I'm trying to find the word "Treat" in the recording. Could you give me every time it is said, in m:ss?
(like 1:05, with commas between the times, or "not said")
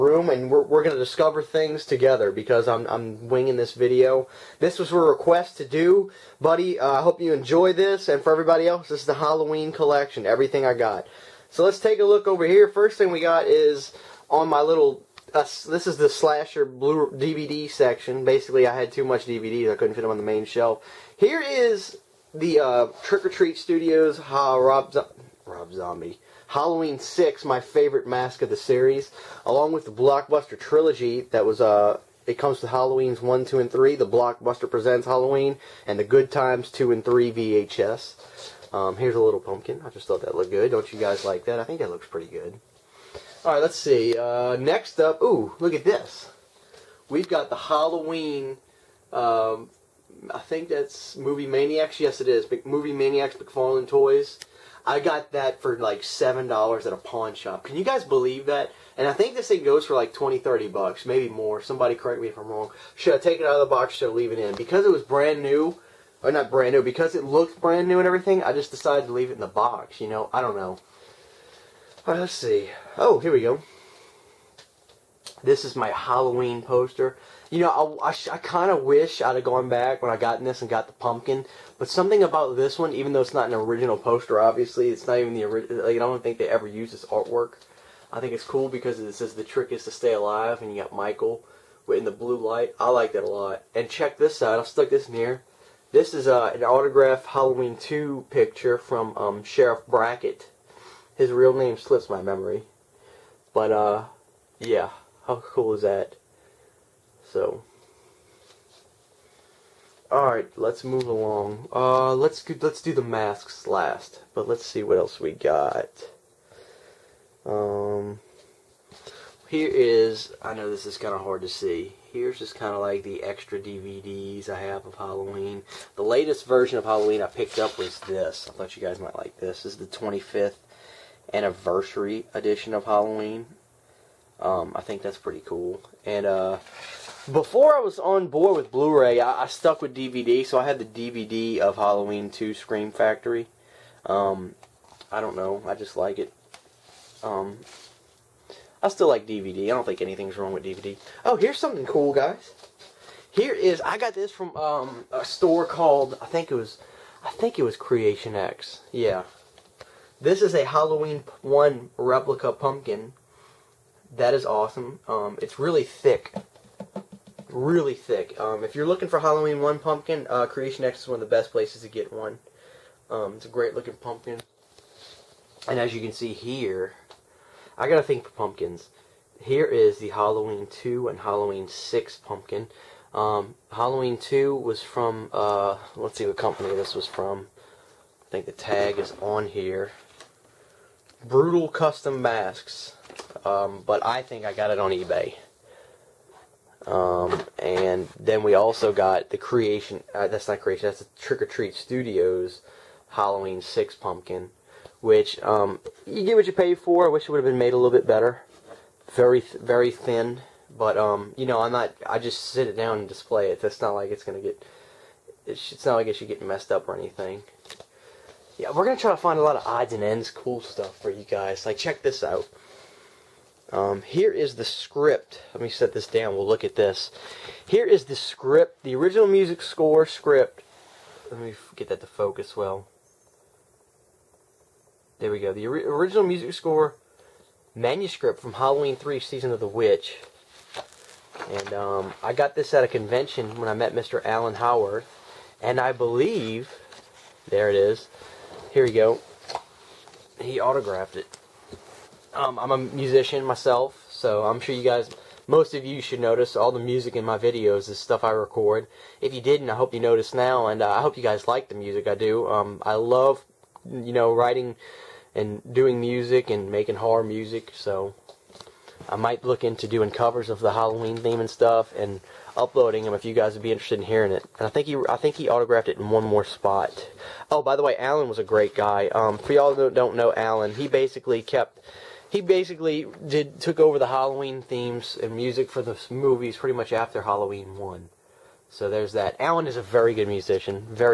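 0:23, 3:21.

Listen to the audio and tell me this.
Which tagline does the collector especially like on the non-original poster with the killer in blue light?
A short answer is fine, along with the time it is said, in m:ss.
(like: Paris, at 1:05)
The trick is to stay alive, at 1:29.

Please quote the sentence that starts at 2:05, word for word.
The latest version of Halloween I picked up was this.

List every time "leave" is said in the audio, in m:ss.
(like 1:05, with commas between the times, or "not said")
1:04, 1:09.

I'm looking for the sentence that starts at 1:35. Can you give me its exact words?
This is uh, an autographed Halloween 2 picture from um, Sheriff Brackett.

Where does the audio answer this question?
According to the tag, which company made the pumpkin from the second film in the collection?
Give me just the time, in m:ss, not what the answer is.
3:11.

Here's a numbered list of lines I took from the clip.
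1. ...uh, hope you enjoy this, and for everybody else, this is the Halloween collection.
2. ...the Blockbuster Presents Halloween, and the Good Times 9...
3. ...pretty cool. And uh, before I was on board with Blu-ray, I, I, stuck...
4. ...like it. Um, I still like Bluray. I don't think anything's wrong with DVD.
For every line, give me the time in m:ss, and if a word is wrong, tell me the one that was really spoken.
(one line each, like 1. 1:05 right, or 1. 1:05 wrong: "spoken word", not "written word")
1. 0:06 right
2. 0:33 wrong: "2", not "9"
3. 2:15 right
4. 2:25 wrong: "DVD", not "Bluray".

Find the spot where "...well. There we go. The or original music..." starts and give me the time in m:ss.
3:52.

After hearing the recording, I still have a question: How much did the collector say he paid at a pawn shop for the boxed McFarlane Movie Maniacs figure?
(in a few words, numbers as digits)
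$7.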